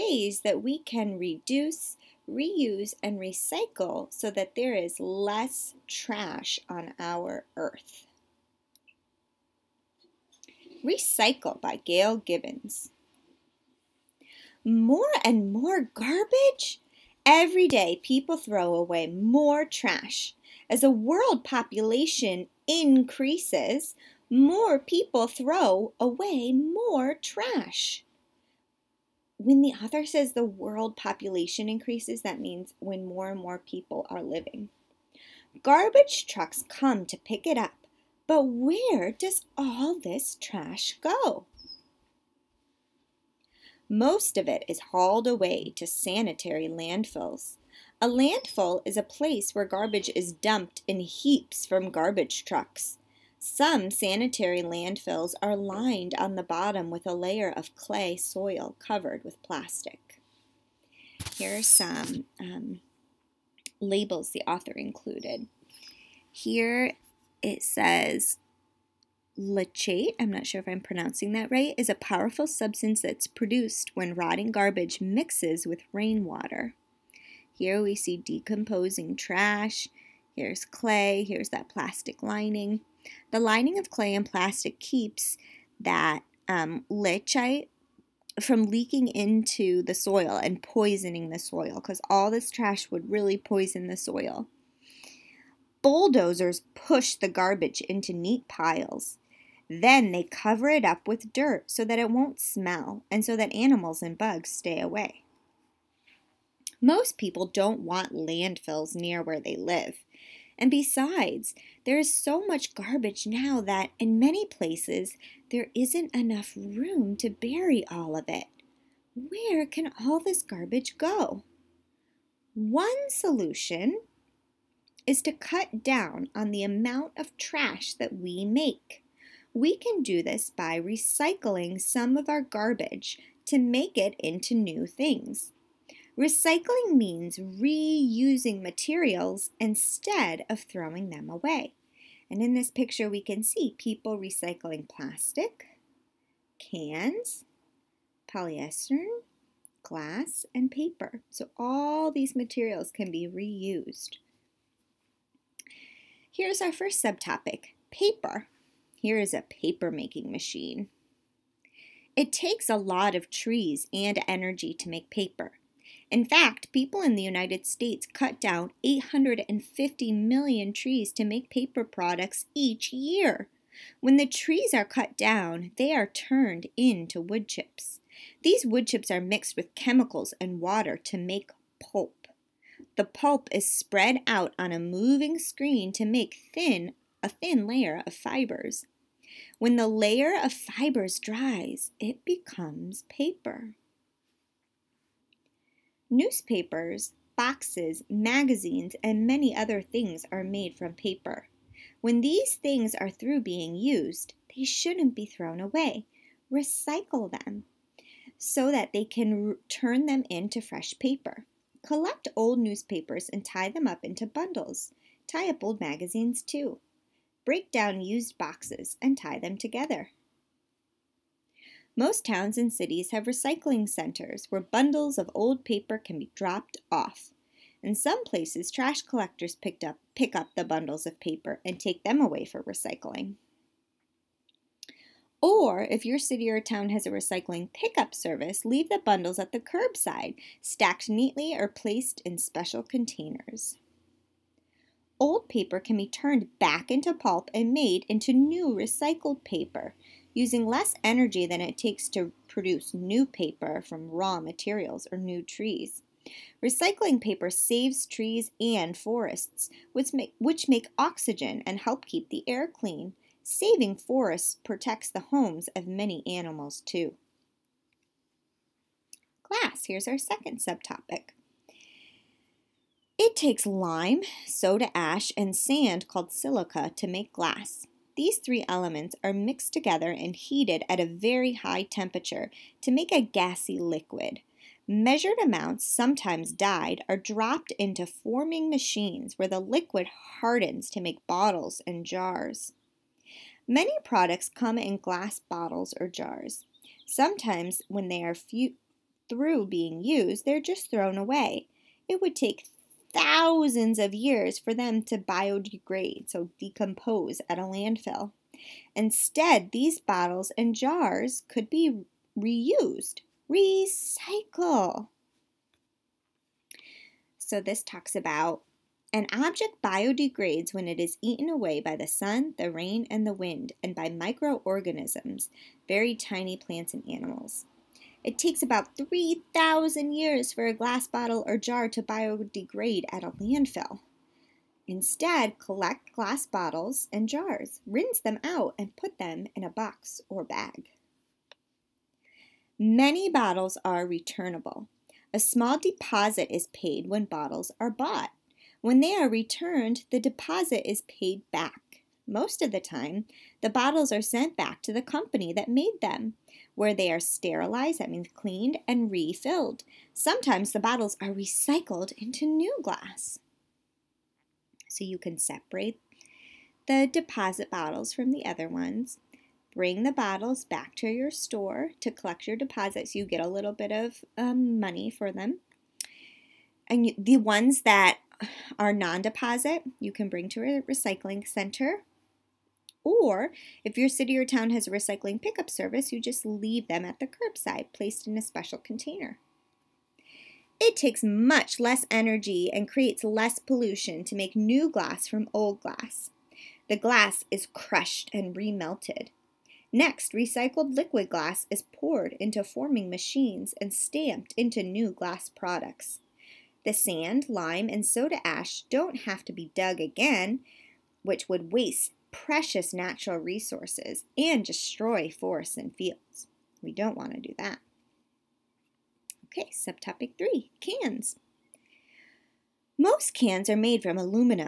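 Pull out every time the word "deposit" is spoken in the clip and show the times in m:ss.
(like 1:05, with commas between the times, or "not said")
5:45, 5:50, 6:07, 6:12, 6:19.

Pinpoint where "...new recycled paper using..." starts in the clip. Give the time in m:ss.
4:08.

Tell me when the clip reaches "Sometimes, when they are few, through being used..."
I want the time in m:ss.
4:57.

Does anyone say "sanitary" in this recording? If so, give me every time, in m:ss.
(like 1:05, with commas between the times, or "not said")
0:45, 0:53.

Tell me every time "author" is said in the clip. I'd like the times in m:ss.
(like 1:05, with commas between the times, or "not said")
0:29, 1:04.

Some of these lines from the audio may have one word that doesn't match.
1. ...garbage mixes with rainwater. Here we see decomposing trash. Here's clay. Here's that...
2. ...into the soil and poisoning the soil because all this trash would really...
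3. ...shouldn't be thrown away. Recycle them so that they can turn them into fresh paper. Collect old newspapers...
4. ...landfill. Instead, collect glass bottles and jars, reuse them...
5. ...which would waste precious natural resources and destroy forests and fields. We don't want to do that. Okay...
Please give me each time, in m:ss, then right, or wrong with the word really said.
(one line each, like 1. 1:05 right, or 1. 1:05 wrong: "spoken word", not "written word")
1. 1:14 right
2. 1:29 right
3. 3:24 right
4. 5:33 wrong: "rinse", not "reuse"
5. 6:51 right.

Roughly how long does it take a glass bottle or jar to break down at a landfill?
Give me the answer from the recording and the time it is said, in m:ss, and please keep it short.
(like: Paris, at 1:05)
3,000 years, at 5:28.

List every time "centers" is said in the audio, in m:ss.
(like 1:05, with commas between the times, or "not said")
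3:43, 6:21.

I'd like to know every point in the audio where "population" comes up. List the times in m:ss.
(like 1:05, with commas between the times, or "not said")
0:21, 0:30.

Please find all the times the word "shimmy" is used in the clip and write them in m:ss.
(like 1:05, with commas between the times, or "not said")
not said.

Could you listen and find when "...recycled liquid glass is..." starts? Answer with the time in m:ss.
6:40.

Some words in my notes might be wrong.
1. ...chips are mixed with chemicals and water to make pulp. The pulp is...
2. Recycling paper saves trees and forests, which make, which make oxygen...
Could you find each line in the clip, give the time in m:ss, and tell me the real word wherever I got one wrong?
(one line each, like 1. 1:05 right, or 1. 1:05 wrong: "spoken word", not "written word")
1. 2:58 right
2. 4:16 right.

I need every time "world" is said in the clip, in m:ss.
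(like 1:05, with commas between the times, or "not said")
0:20, 0:30.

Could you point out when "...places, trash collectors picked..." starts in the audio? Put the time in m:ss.
3:48.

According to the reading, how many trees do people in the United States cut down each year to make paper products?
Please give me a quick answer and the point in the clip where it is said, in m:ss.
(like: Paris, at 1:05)
850 million, at 2:48.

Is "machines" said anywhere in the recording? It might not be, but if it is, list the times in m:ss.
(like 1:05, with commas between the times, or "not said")
2:40, 4:48, 6:43.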